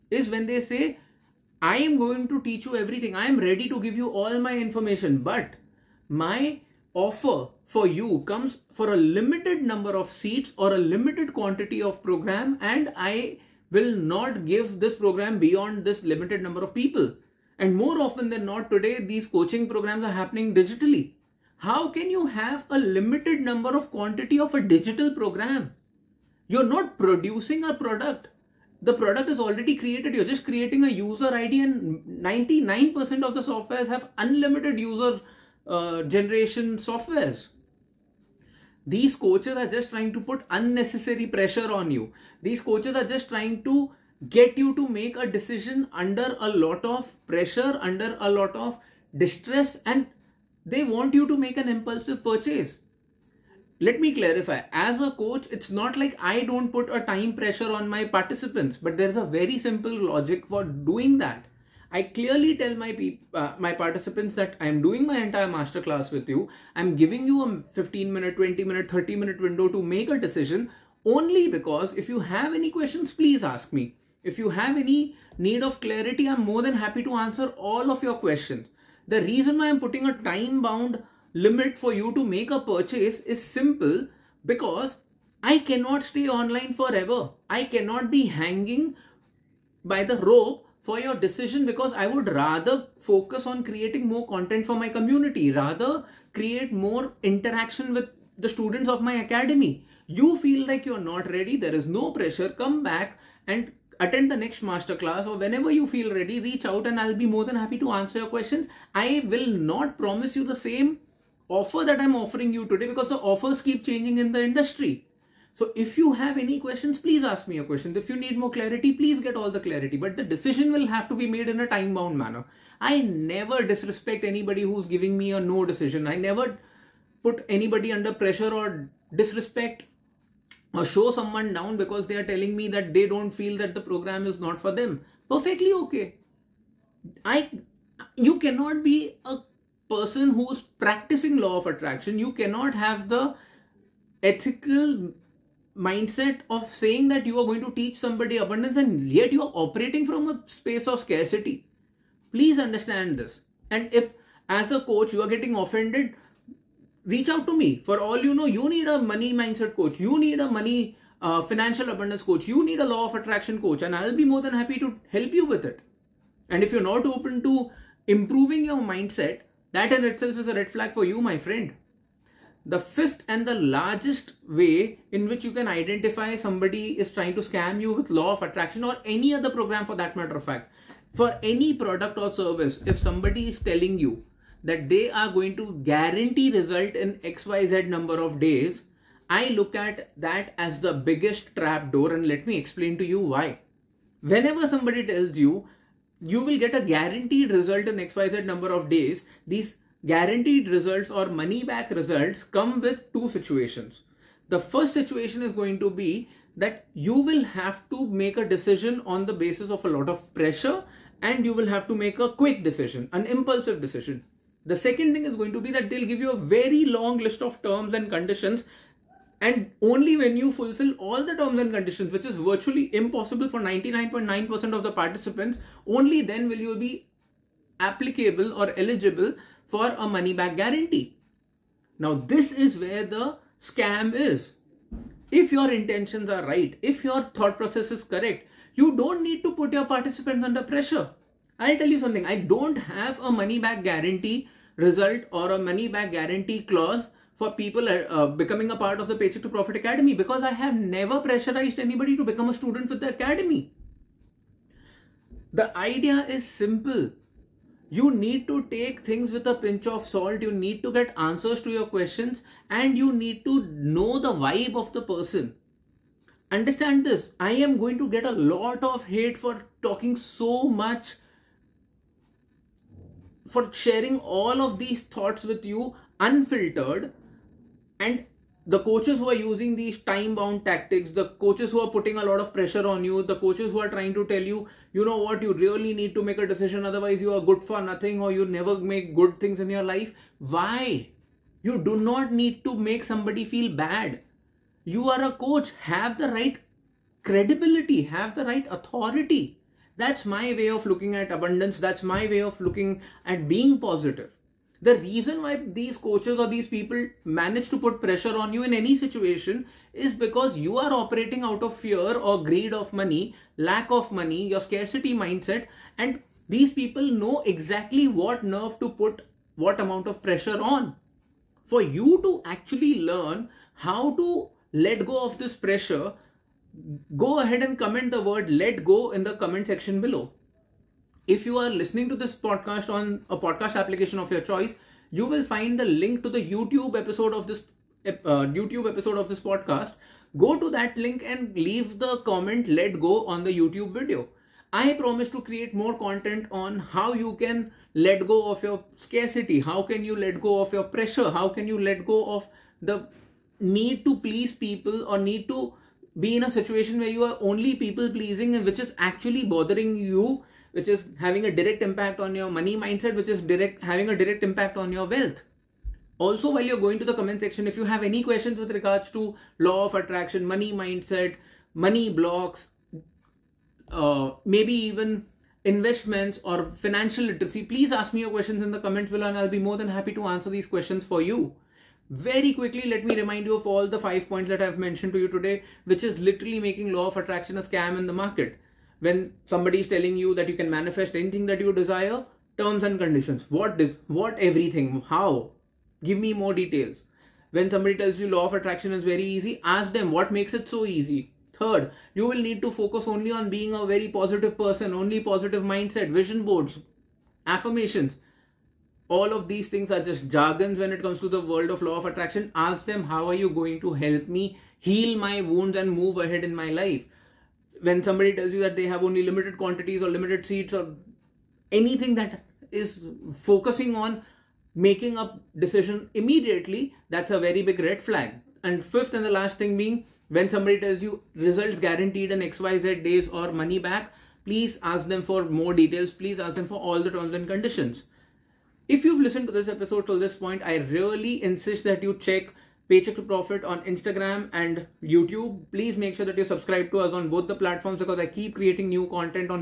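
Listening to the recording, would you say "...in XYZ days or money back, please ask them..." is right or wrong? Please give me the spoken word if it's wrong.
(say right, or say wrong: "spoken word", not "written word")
right.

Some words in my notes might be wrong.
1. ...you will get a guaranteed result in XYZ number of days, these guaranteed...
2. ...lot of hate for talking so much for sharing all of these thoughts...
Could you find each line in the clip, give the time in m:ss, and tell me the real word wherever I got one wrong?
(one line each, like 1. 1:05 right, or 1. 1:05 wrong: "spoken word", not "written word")
1. 3:16 right
2. 4:28 right.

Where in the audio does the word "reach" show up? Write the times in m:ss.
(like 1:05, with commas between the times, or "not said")
1:46, 2:37.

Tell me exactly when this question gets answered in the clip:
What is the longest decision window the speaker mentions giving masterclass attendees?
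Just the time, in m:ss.
1:08.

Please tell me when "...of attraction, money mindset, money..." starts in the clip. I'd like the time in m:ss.
6:09.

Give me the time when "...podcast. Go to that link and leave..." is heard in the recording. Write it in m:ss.
5:39.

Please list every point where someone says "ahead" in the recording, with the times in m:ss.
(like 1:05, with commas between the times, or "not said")
5:27, 6:56.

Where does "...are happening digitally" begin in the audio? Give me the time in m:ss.
0:20.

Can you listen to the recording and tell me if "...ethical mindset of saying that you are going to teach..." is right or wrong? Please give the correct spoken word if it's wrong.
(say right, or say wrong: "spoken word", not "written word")
right.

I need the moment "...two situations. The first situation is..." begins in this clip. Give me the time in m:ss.
3:23.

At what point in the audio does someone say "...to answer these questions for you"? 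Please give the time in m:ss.
6:20.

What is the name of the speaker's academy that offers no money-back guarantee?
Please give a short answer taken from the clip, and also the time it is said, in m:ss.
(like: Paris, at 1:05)
Paycheck to Profit Academy, at 4:09.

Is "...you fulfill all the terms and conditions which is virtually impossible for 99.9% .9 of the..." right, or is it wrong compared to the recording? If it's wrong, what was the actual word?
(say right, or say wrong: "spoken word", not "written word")
right.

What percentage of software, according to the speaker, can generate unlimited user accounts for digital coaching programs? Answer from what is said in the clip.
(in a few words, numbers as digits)
99%.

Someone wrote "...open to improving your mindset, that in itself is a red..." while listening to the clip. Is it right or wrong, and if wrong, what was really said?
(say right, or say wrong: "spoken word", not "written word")
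right.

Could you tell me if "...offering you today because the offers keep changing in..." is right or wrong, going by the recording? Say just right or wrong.
right.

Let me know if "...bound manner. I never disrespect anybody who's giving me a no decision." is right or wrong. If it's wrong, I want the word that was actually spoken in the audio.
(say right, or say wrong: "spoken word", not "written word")
right.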